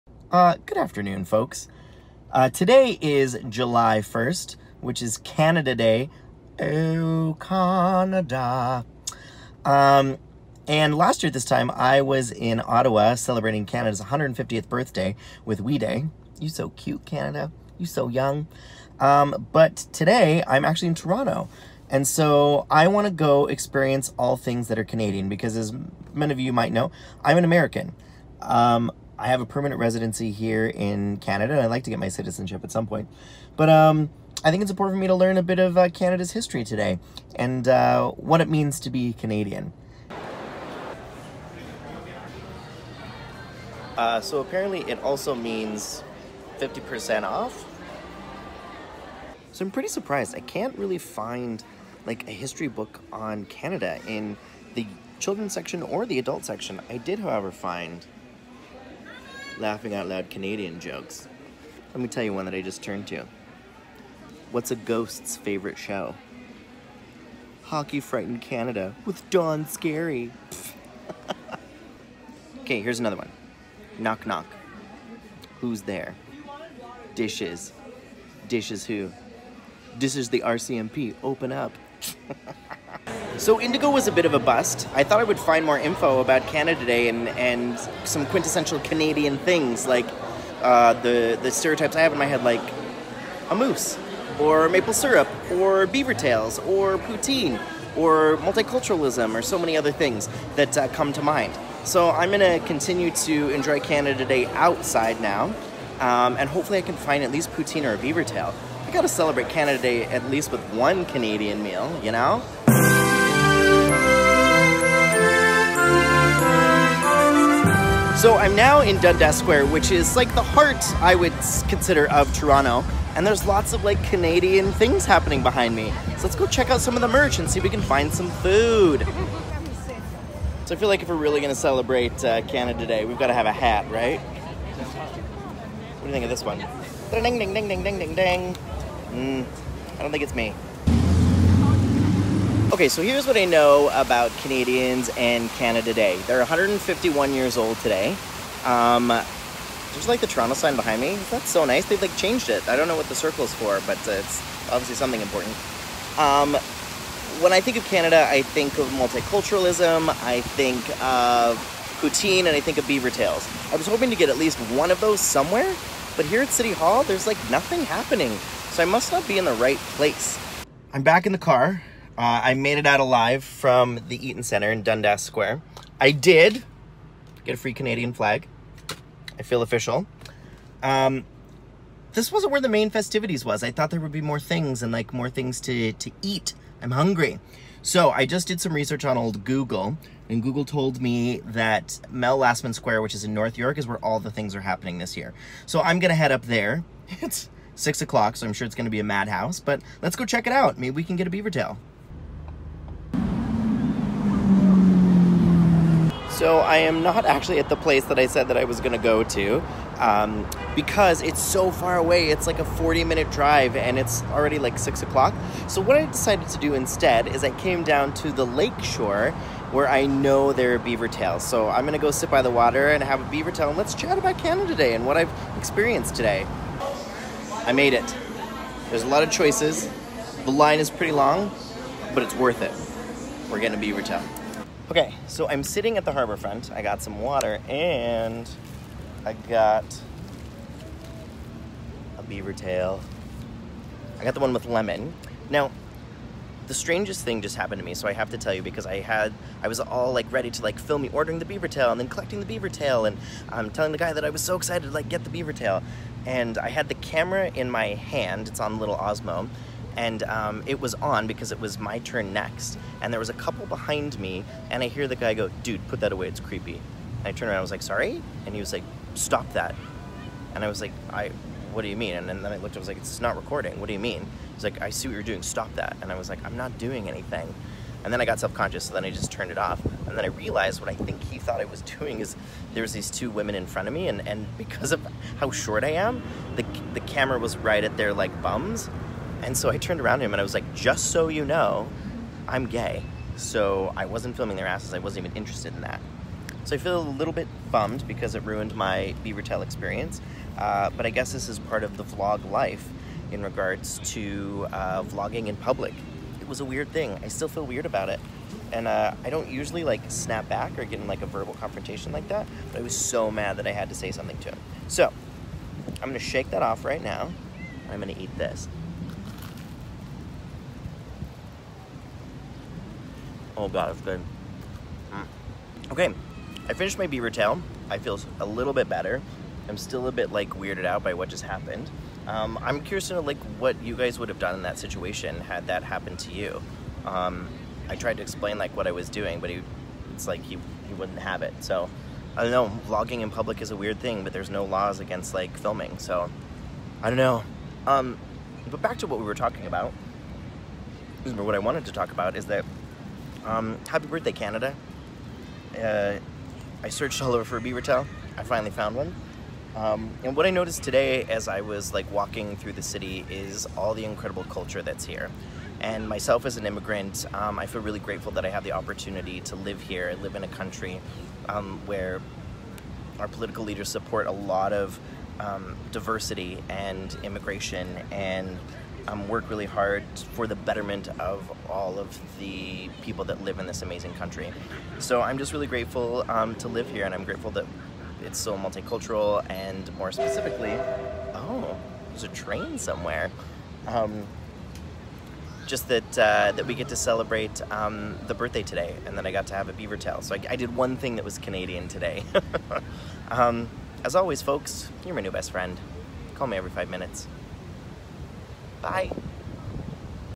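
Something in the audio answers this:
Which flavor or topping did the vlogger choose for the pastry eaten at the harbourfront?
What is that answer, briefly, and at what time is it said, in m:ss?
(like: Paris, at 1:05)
Lemon, at 4:04.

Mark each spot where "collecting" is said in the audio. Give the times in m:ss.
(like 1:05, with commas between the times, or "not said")
4:12.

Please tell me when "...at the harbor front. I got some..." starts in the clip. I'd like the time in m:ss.
3:55.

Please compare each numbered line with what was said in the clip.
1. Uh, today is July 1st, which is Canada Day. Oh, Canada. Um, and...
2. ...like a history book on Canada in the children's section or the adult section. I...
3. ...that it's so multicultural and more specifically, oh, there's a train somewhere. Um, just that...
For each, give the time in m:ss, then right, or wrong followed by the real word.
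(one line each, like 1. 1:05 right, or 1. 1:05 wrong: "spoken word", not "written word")
1. 0:02 right
2. 0:52 right
3. 6:27 right.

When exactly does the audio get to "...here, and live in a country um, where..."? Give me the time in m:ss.
6:09.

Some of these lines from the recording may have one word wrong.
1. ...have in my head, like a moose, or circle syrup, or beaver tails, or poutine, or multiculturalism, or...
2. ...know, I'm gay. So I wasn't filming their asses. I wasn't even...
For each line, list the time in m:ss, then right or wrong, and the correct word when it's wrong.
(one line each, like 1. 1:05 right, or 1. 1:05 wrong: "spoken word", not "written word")
1. 1:32 wrong: "maple", not "circle"
2. 4:51 right.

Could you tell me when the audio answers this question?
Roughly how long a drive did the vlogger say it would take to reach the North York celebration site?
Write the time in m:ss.
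3:32.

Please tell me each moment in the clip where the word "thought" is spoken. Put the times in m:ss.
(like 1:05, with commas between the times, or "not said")
1:25, 3:03, 4:41.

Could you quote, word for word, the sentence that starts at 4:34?
He's like, I see what you're doing, stop that.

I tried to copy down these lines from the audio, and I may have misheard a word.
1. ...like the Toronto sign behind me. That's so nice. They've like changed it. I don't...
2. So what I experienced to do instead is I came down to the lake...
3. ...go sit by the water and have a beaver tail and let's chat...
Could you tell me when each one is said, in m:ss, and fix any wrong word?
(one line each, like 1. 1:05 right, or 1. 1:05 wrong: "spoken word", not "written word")
1. 2:30 right
2. 3:35 wrong: "decided", not "experienced"
3. 3:42 right.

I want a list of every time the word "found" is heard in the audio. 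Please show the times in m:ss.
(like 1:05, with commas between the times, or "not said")
5:58.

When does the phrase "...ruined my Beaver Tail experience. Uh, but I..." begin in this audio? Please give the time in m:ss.
4:58.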